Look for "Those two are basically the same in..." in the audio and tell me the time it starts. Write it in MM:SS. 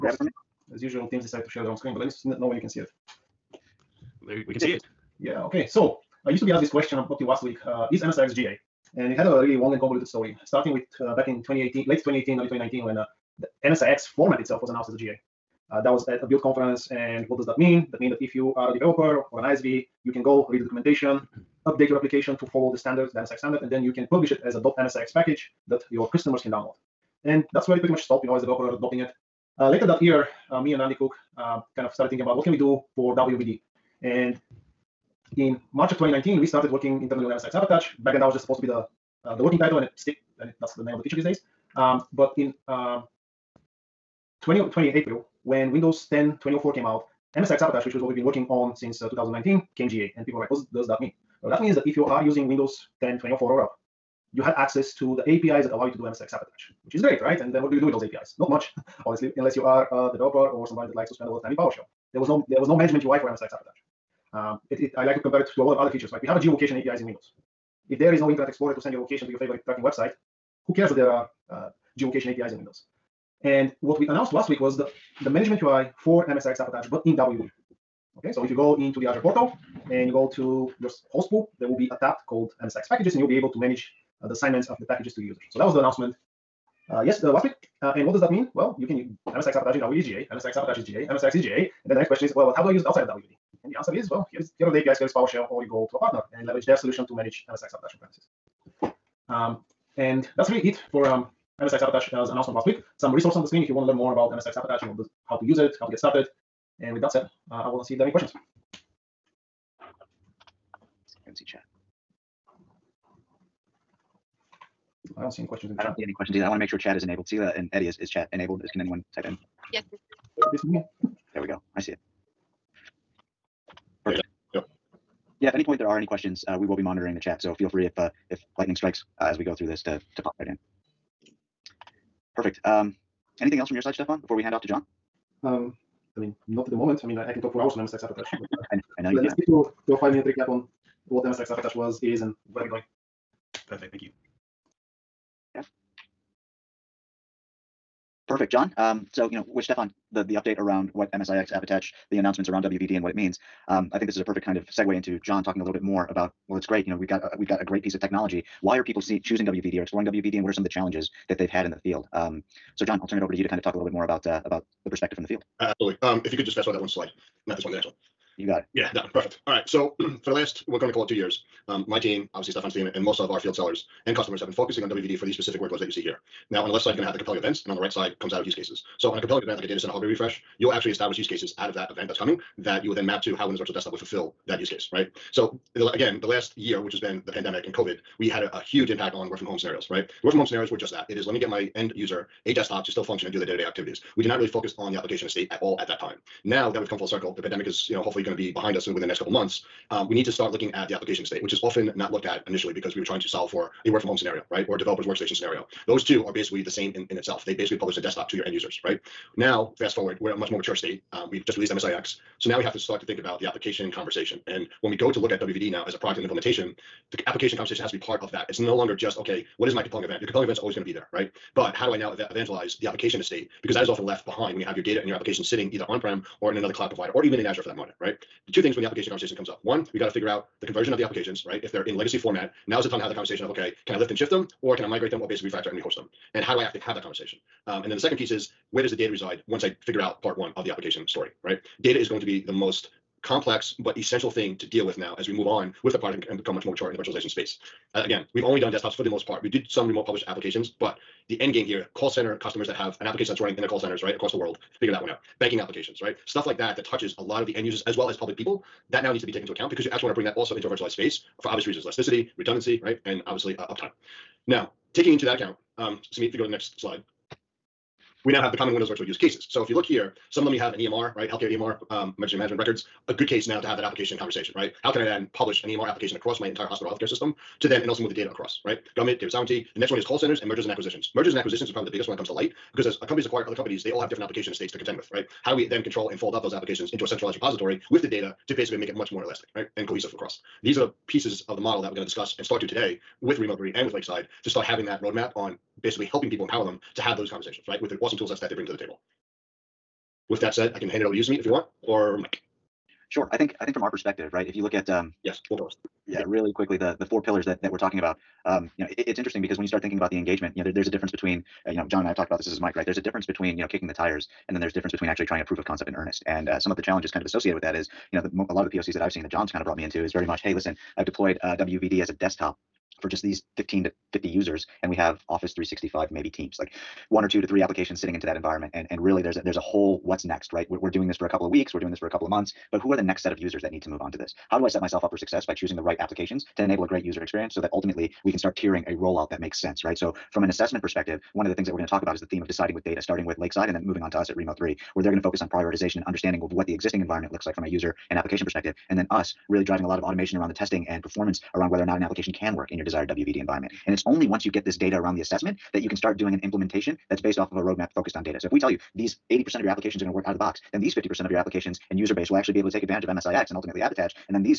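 03:25.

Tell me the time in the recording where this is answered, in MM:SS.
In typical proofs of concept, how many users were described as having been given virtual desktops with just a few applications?
05:23.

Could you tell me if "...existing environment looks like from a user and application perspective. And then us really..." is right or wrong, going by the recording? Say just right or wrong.
right.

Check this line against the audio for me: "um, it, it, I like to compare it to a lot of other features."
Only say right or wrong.
right.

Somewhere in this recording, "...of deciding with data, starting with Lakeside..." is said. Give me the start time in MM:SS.
05:42.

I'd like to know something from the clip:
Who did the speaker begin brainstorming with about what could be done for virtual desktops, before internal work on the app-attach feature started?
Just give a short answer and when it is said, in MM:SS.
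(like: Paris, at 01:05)
Randy Cook, at 00:30.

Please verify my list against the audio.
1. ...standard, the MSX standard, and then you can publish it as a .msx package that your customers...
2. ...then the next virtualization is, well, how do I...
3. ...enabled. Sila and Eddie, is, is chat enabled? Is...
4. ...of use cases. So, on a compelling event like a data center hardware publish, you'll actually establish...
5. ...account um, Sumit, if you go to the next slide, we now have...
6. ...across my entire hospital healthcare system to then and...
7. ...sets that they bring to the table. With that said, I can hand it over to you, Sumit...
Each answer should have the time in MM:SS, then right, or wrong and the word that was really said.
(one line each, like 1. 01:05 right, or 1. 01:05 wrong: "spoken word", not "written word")
1. 00:22 right
2. 01:31 wrong: "question", not "virtualization"
3. 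01:57 right
4. 02:58 wrong: "refresh", not "publish"
5. 04:25 right
6. 04:36 right
7. 04:58 right.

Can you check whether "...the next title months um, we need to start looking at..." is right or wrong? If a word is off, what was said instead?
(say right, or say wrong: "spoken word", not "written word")
wrong: "couple", not "title".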